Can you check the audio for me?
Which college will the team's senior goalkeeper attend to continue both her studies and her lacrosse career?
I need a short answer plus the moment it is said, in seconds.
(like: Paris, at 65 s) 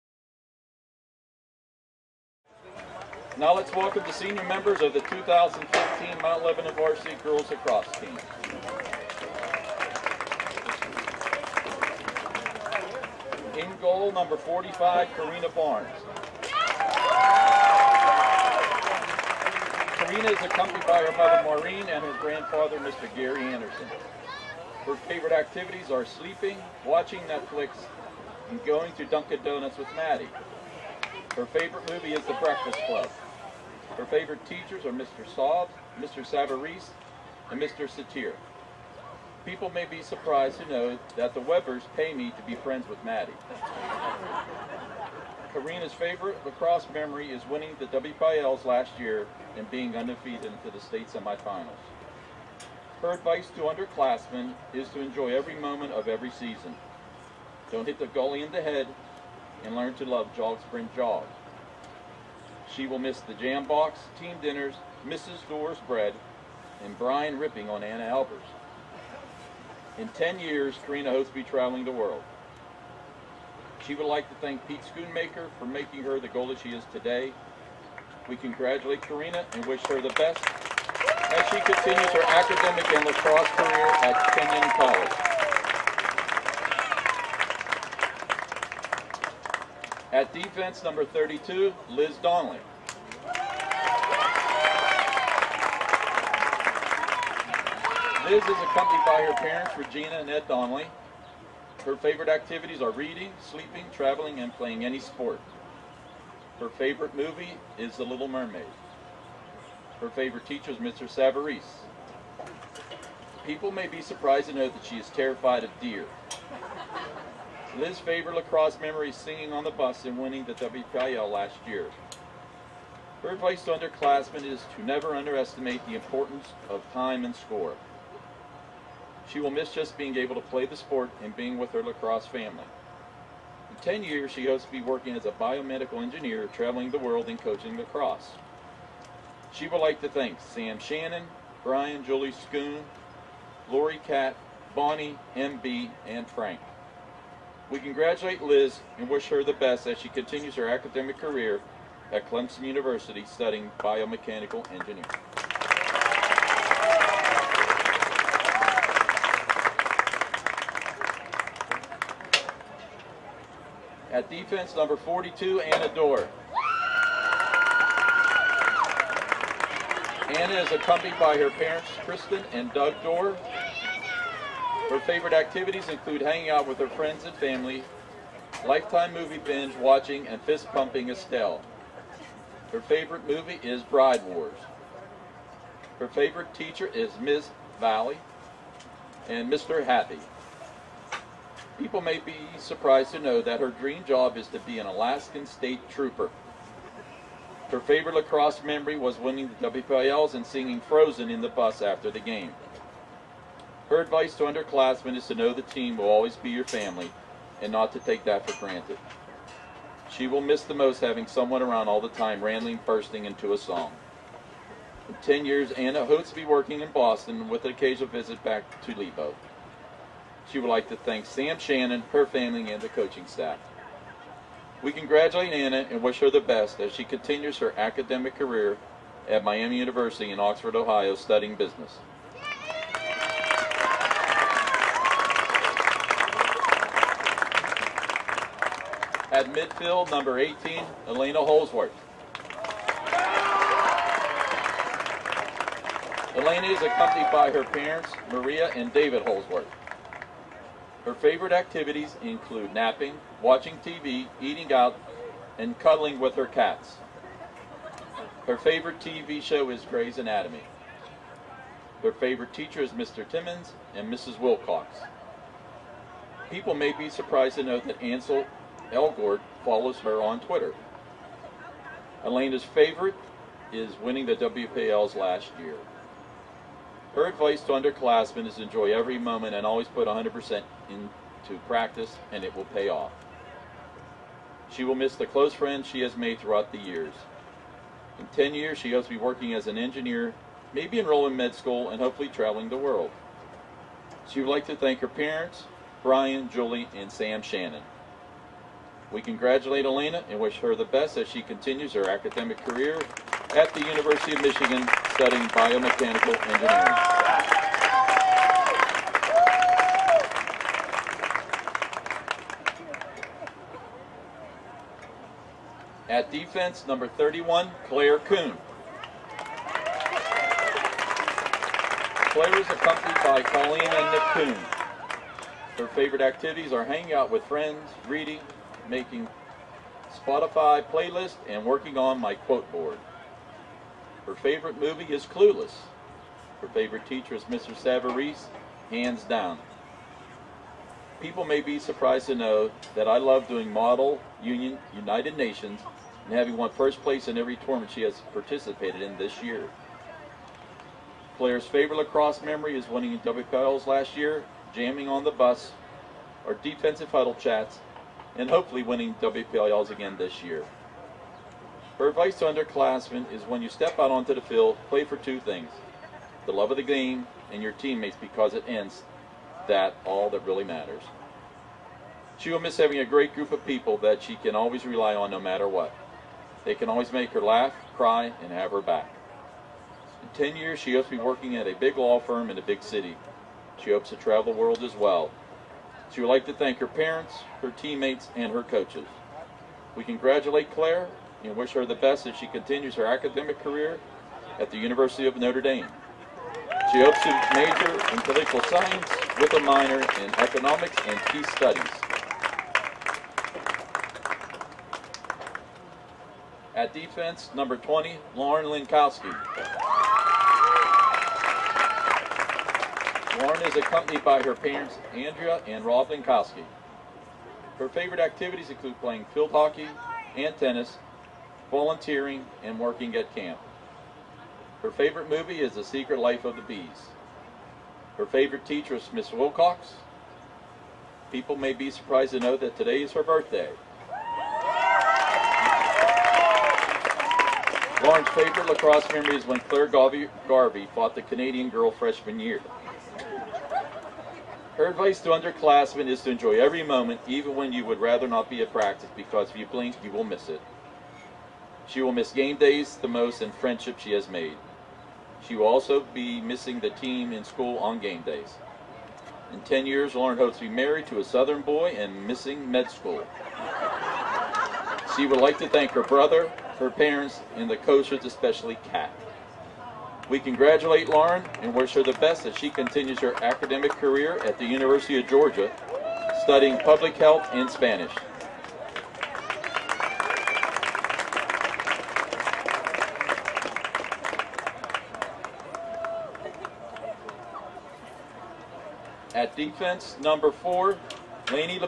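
Kenyon College, at 84 s.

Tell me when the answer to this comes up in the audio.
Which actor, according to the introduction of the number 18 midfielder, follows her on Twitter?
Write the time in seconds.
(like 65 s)
268 s.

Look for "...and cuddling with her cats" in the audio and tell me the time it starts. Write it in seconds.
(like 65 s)
255 s.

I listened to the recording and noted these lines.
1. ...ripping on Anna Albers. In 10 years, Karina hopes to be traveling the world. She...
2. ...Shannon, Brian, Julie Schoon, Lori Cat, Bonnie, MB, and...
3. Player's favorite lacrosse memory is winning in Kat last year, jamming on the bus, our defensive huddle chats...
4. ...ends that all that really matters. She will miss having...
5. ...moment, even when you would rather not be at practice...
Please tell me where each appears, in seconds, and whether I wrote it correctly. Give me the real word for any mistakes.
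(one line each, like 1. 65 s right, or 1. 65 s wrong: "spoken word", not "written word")
1. 67 s right
2. 140 s right
3. 351 s wrong: "WPLs", not "Kat"
4. 368 s right
5. 446 s right.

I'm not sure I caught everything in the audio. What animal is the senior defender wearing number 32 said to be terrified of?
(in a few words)
Deer.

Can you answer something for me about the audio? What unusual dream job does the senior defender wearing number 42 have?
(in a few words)
Alaskan state trooper.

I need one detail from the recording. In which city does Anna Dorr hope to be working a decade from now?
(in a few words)
Boston.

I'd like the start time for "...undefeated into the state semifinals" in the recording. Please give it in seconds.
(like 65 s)
49 s.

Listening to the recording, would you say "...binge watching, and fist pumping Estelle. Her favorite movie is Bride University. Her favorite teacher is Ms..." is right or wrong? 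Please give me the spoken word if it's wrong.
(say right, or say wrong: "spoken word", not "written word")
wrong: "Wars", not "University".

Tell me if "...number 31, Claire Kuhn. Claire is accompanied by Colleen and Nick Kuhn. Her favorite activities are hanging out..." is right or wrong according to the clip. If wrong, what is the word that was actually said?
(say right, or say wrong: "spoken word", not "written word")
right.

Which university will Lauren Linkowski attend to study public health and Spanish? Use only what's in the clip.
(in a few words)
University of Georgia.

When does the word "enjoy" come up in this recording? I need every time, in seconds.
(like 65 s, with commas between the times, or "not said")
54 s, 278 s, 446 s.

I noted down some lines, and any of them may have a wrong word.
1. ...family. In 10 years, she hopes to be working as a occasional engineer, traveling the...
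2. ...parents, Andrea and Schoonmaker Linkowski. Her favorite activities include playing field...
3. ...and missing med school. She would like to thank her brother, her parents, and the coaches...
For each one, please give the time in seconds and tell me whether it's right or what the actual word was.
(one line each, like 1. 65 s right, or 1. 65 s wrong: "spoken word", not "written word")
1. 132 s wrong: "biomedical", not "occasional"
2. 414 s wrong: "Rob", not "Schoonmaker"
3. 461 s right.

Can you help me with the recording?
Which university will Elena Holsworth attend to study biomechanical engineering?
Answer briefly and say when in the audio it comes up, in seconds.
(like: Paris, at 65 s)
University of Michigan, at 303 s.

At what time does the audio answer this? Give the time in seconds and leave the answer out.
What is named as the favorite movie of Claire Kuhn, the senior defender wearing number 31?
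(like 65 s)
335 s.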